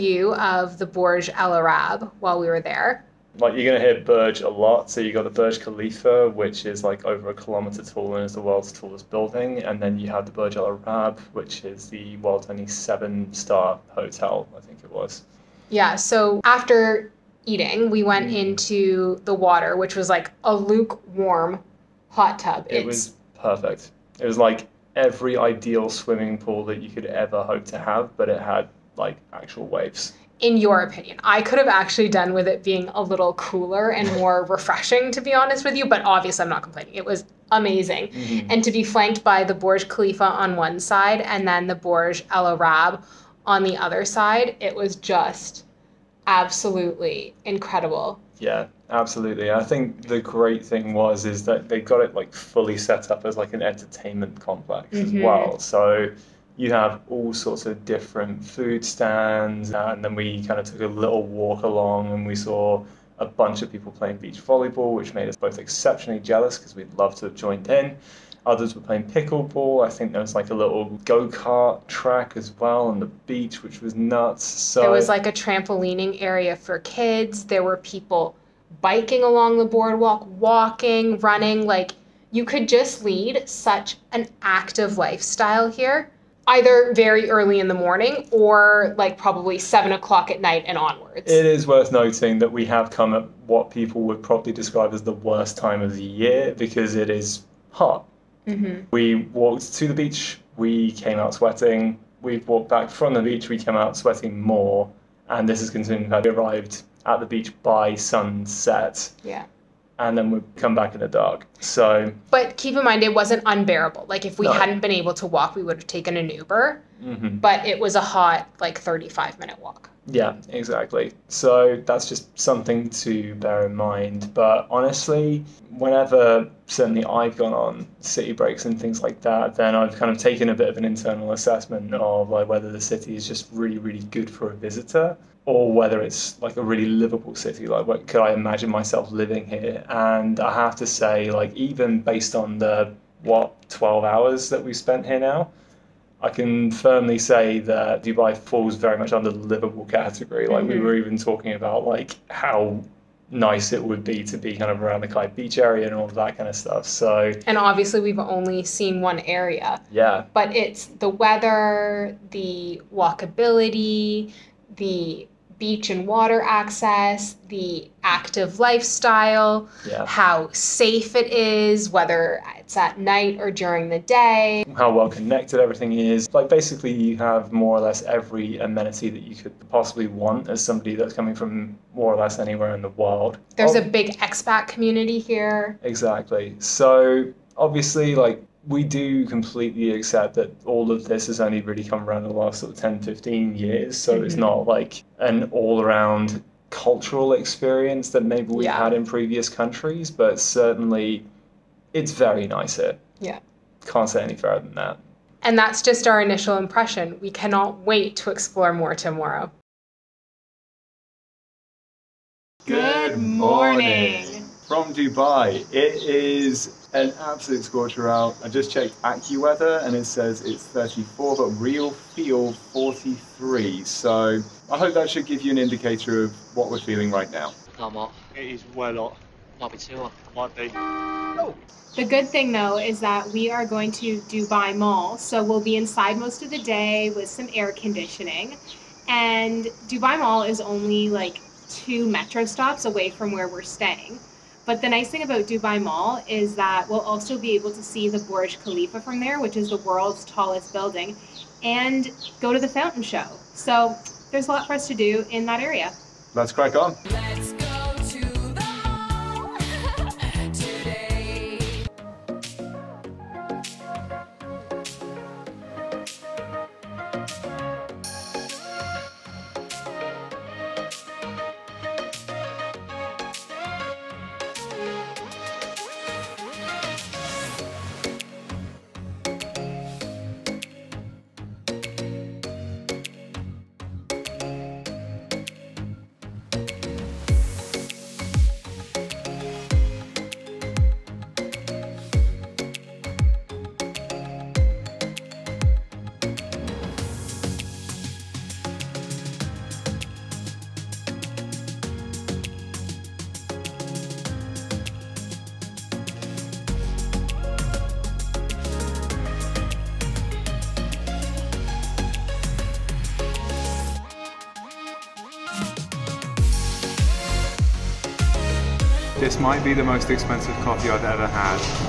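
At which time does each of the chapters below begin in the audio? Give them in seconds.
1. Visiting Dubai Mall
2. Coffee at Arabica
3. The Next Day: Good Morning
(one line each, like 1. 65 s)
1. 263 s
2. 310 s
3. 212 s.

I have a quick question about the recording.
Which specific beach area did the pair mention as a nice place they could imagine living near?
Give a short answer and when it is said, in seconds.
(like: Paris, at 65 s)
Kite Beach, at 155 s.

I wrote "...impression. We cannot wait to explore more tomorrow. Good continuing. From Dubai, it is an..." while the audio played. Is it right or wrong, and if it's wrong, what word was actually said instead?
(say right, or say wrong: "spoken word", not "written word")
wrong: "morning", not "continuing".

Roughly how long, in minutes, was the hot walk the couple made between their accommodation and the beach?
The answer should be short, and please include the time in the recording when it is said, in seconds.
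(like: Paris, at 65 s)
35 minutes, at 118 s.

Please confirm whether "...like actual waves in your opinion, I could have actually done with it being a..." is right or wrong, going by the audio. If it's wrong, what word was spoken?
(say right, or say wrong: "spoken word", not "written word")
right.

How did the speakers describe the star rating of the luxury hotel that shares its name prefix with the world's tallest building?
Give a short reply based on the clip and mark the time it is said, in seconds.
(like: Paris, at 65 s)
7-star, at 12 s.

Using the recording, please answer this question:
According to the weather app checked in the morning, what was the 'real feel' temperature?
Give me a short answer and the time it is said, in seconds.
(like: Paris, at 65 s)
43, at 222 s.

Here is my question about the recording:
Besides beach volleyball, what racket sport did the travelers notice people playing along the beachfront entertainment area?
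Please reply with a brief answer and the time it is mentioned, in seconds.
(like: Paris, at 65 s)
Pickleball, at 69 s.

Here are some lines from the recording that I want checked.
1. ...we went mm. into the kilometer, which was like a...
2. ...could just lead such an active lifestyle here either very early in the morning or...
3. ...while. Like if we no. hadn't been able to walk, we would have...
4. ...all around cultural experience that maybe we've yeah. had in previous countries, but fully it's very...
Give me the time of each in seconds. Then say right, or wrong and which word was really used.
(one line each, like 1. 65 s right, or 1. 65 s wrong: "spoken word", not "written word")
1. 17 s wrong: "water", not "kilometer"
2. 82 s right
3. 113 s wrong: "unbearable", not "while"
4. 195 s wrong: "certainly", not "fully".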